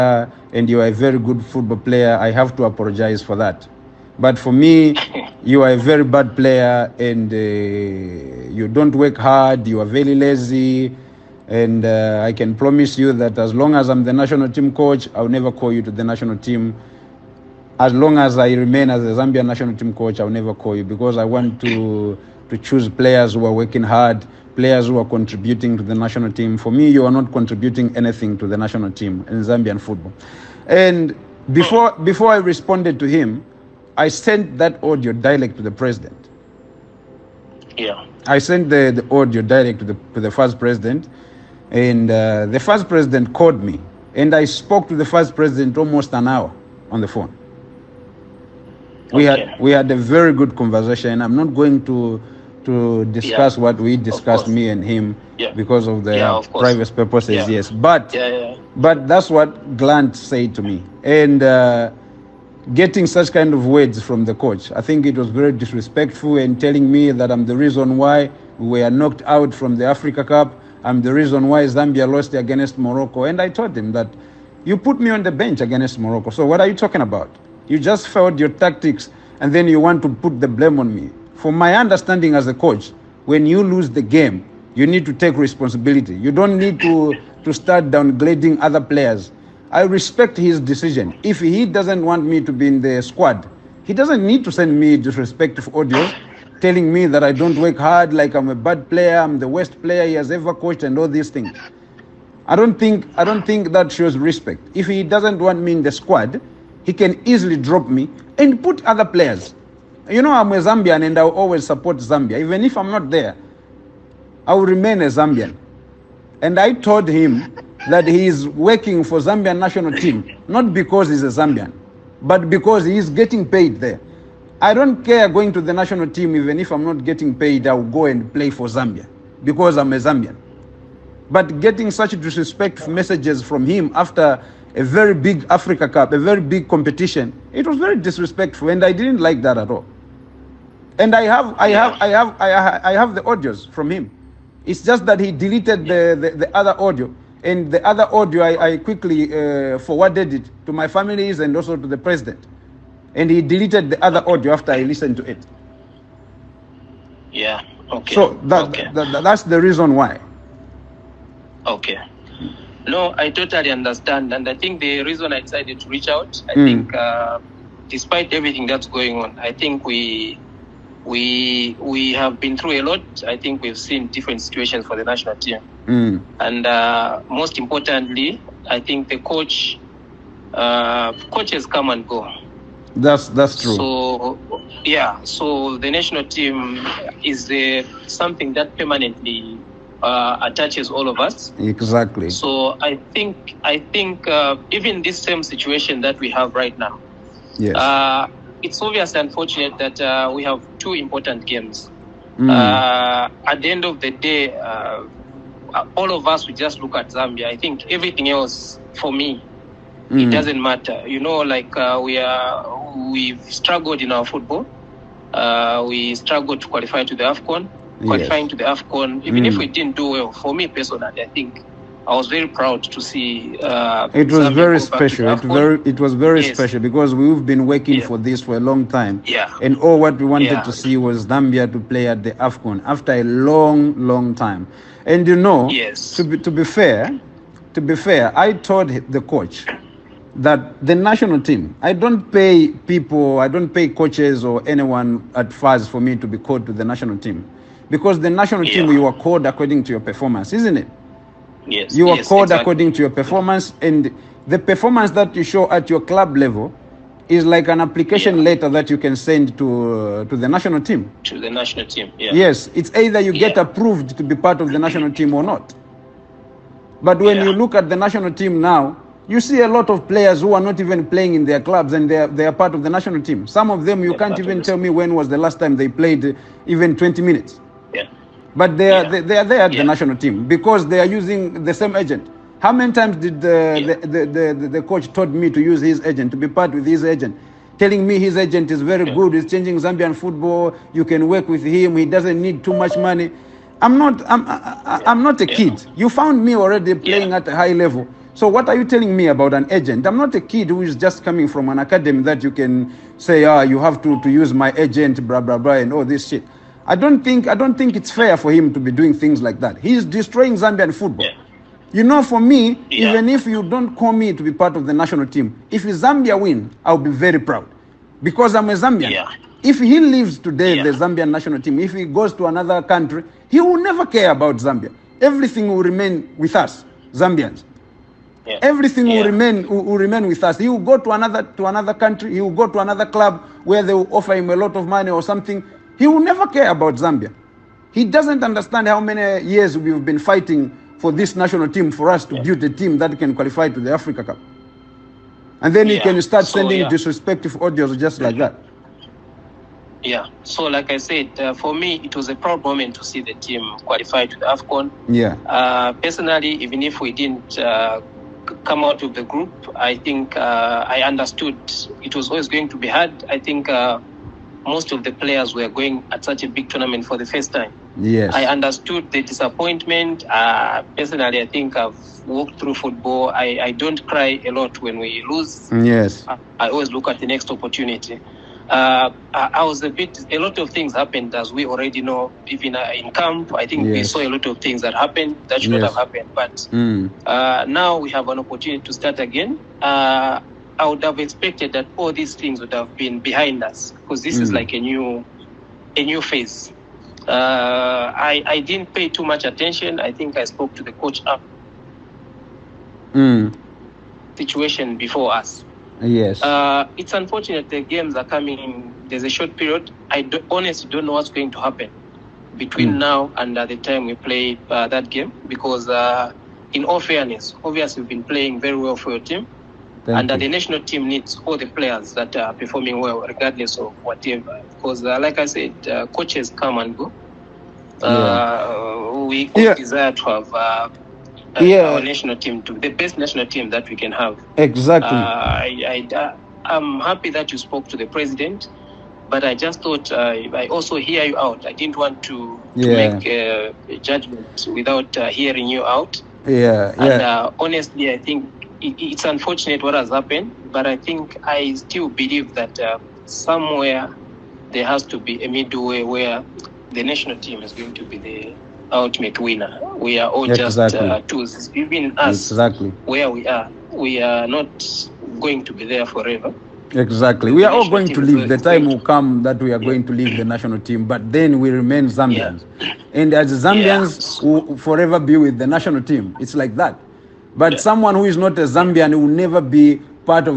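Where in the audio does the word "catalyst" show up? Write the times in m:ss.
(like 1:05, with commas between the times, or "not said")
not said.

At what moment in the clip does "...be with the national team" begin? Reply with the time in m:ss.
7:55.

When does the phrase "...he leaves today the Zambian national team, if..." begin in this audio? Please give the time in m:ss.
5:19.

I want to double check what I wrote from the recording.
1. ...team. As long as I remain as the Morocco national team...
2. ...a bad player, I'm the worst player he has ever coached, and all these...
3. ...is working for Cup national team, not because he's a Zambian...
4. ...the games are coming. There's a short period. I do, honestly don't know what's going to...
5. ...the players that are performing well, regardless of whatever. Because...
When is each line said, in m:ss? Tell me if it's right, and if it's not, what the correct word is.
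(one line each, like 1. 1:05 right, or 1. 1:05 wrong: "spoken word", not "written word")
1. 0:16 wrong: "Zambian", not "Morocco"
2. 1:38 right
3. 1:58 wrong: "Zambian", not "Cup"
4. 6:47 right
5. 7:01 right.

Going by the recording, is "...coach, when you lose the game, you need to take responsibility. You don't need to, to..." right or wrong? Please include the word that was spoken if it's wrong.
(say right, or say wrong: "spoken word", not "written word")
right.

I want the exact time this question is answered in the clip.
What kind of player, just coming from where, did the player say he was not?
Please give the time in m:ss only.
5:01.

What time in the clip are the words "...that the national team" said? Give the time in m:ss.
4:00.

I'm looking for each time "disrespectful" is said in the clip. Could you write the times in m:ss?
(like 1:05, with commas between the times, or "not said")
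1:05, 1:34, 2:12, 2:17, 5:46.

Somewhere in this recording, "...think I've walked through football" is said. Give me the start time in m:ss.
6:11.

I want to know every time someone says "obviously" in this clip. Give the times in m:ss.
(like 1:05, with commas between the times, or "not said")
3:18, 6:57.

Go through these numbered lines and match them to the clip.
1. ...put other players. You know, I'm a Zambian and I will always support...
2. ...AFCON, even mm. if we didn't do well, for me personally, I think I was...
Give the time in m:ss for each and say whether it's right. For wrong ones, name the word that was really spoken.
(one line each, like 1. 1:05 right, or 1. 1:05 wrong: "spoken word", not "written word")
1. 1:48 right
2. 3:38 right.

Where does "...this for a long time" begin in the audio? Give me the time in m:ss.
3:48.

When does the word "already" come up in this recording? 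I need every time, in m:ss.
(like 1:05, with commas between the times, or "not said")
4:56, 6:21.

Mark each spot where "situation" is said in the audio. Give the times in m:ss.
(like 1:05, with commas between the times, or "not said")
2:54, 3:15, 6:44.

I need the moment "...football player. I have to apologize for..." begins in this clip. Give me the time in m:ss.
0:01.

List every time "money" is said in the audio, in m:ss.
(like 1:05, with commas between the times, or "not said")
4:52, 5:34.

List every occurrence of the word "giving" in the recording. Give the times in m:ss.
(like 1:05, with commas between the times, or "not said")
not said.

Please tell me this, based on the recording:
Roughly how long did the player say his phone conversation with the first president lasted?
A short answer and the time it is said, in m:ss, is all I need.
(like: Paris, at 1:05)
almost an hour, at 0:45.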